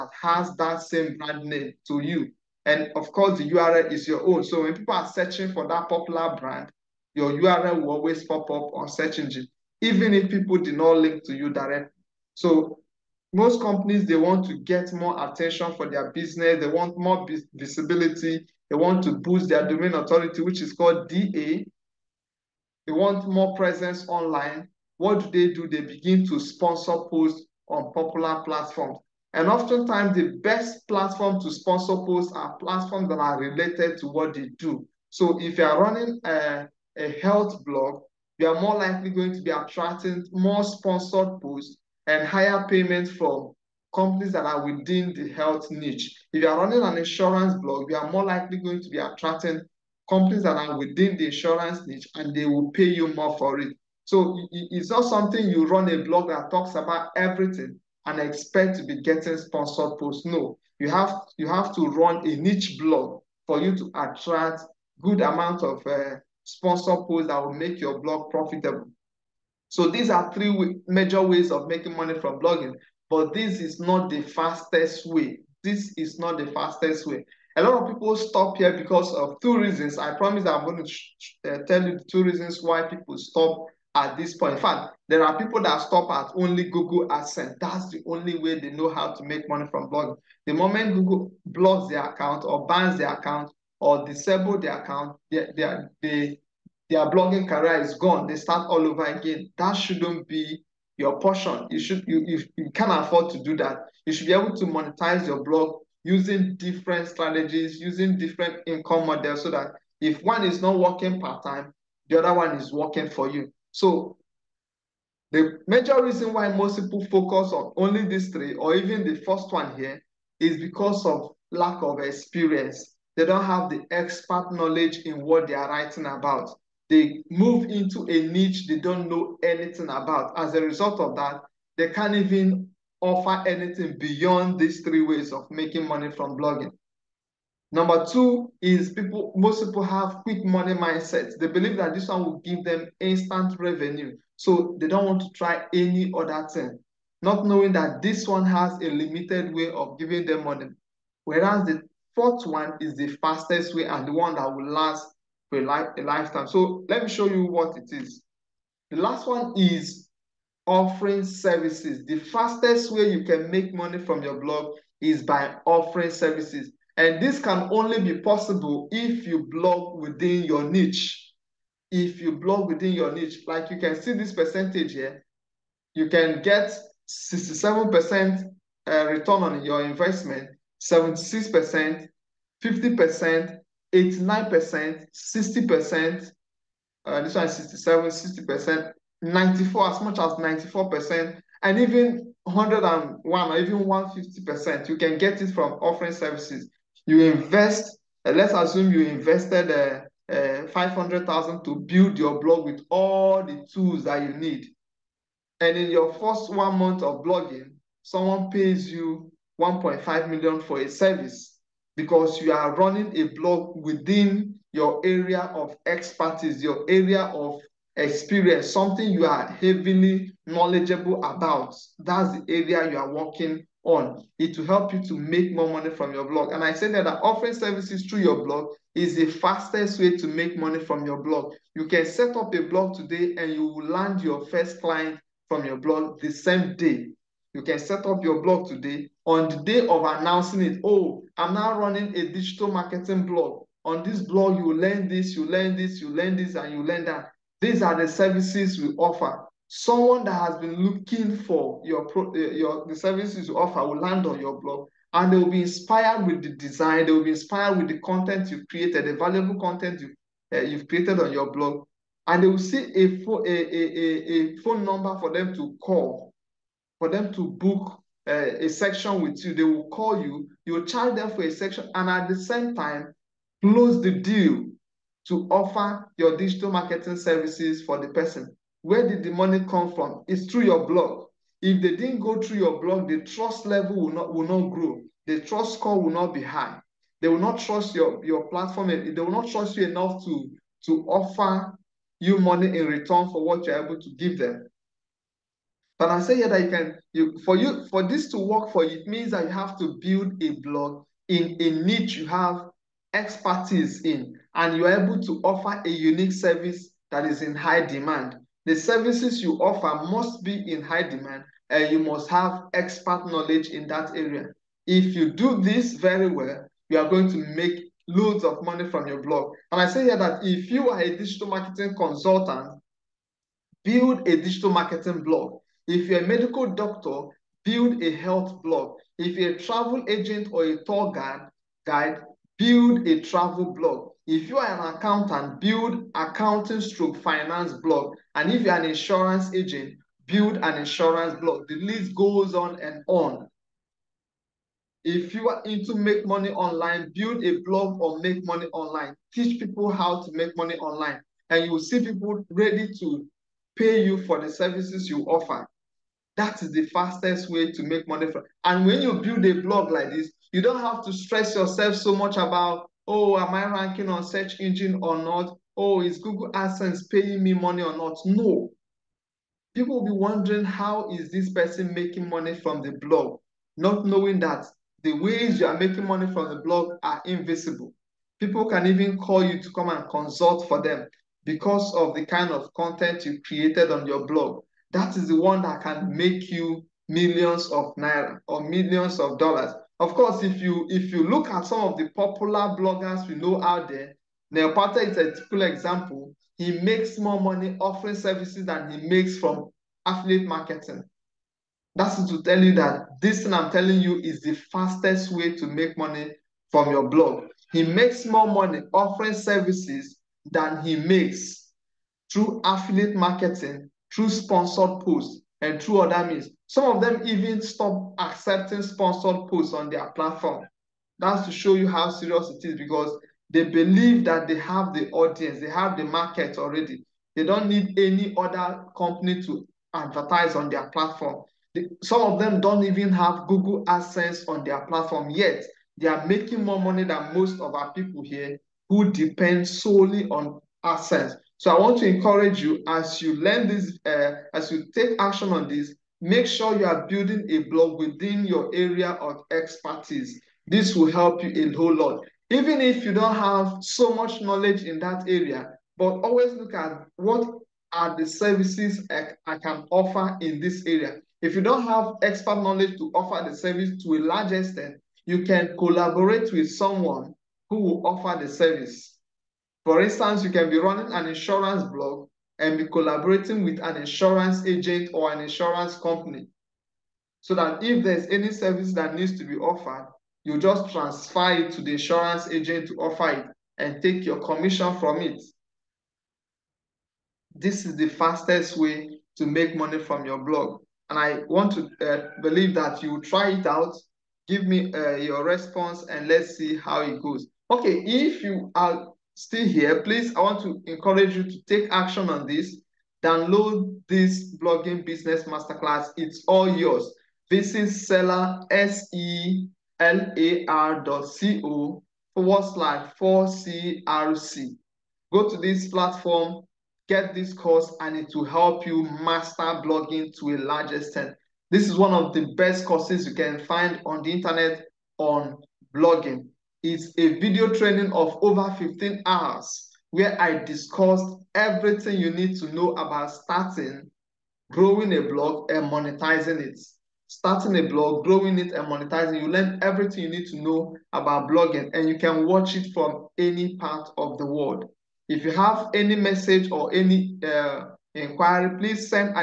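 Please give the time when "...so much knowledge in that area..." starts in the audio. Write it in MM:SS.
07:33.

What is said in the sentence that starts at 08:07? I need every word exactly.
This is the fastest way to make money from your blog.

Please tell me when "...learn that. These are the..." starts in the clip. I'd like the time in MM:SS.
04:06.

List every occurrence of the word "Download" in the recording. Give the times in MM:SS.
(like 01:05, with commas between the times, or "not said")
08:23.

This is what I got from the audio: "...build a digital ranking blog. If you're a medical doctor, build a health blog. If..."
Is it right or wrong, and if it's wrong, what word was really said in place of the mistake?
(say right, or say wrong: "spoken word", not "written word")
wrong: "marketing", not "ranking".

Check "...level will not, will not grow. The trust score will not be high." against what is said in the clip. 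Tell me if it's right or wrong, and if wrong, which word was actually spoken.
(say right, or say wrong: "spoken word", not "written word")
right.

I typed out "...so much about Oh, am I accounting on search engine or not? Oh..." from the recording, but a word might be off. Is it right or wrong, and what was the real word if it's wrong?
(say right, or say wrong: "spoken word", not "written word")
wrong: "ranking", not "accounting".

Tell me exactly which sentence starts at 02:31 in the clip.
Whereas the fourth one is the fastest way and the one that will last for a, life, a lifetime.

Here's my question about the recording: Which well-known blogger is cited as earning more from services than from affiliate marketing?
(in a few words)
Neil Patel.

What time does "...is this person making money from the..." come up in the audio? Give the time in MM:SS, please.
06:11.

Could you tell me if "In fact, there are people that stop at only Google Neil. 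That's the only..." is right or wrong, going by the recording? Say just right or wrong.
wrong.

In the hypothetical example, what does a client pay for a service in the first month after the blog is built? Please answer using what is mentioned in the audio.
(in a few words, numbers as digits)
1.5 million.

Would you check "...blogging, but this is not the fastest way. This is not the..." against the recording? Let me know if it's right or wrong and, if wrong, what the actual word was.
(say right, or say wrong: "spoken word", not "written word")
right.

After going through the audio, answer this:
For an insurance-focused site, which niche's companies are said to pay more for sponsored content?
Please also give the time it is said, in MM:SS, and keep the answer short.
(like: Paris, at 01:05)
insurance niche, at 00:51.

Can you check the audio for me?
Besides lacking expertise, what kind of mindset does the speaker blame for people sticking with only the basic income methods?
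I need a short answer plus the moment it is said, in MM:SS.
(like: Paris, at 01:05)
quick money mindset, at 02:20.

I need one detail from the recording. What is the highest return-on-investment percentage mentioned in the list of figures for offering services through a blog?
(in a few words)
150%.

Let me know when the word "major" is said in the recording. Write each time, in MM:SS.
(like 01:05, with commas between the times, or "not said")
01:10, 01:55.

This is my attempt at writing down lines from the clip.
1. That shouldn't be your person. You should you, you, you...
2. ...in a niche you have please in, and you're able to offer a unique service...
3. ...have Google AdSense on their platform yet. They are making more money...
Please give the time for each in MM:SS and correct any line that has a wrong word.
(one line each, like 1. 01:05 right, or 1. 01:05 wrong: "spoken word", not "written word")
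1. 01:39 wrong: "portion", not "person"
2. 05:01 wrong: "expertise", not "please"
3. 07:13 right.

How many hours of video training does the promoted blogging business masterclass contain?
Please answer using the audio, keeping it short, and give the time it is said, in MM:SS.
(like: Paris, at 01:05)
over 15 hours, at 08:48.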